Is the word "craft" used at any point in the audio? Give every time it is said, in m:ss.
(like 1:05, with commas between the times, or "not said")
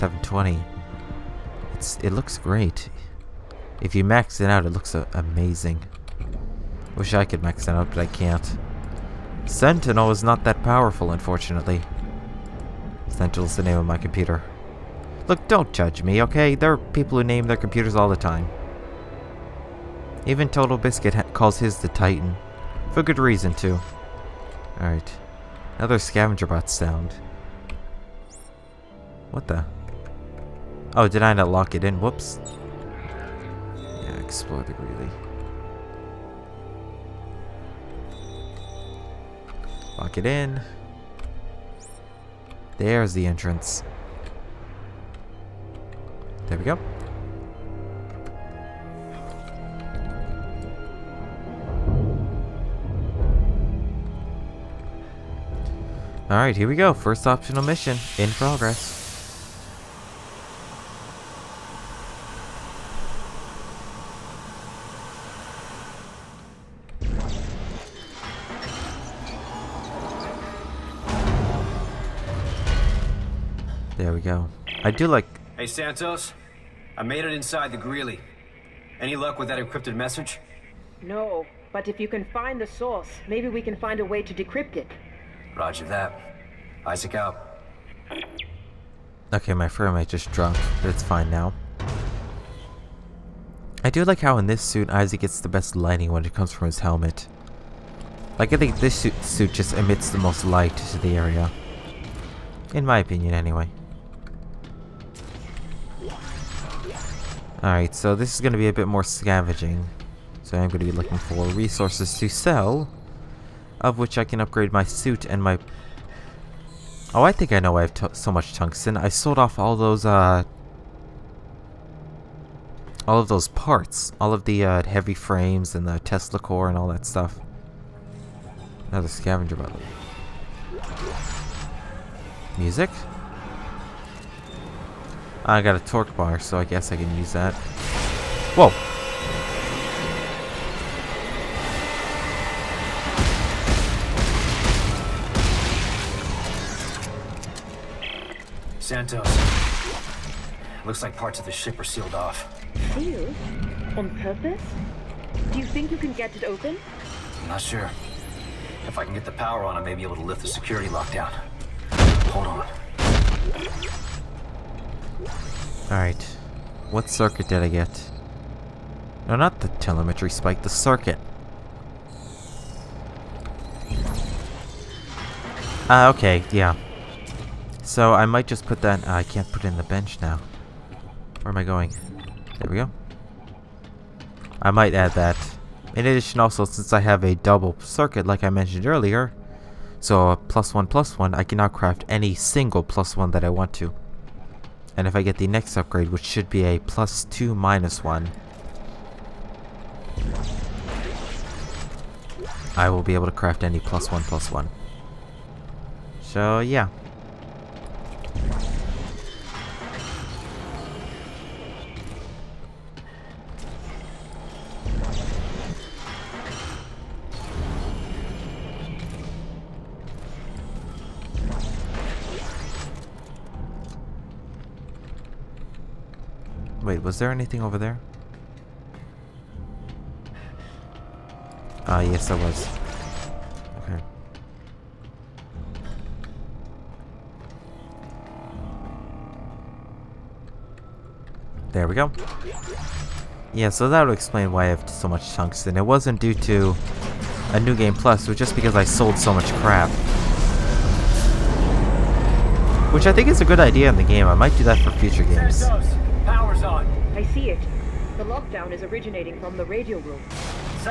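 3:11, 3:23.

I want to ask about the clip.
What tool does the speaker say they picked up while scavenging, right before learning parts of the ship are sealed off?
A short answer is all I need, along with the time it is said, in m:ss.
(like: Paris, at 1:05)
torque bar, at 2:15.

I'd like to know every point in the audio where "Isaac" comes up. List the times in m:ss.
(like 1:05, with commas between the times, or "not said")
1:26, 1:34.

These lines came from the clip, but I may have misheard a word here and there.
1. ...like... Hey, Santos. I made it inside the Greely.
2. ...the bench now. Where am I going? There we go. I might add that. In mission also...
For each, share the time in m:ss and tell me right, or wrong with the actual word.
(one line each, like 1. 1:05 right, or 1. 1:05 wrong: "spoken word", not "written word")
1. 1:15 right
2. 2:59 wrong: "addition", not "mission".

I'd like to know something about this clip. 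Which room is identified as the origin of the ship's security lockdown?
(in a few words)
the radio room.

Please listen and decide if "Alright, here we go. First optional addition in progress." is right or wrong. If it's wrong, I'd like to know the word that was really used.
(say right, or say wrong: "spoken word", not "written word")
wrong: "mission", not "addition".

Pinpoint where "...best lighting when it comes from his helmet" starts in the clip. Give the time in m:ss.
1:35.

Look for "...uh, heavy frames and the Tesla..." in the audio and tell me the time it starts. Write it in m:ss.
2:04.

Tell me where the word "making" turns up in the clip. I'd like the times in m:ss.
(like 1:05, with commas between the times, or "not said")
not said.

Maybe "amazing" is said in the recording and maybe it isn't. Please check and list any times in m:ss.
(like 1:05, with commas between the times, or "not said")
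0:05.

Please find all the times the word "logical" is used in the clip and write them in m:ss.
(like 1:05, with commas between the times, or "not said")
not said.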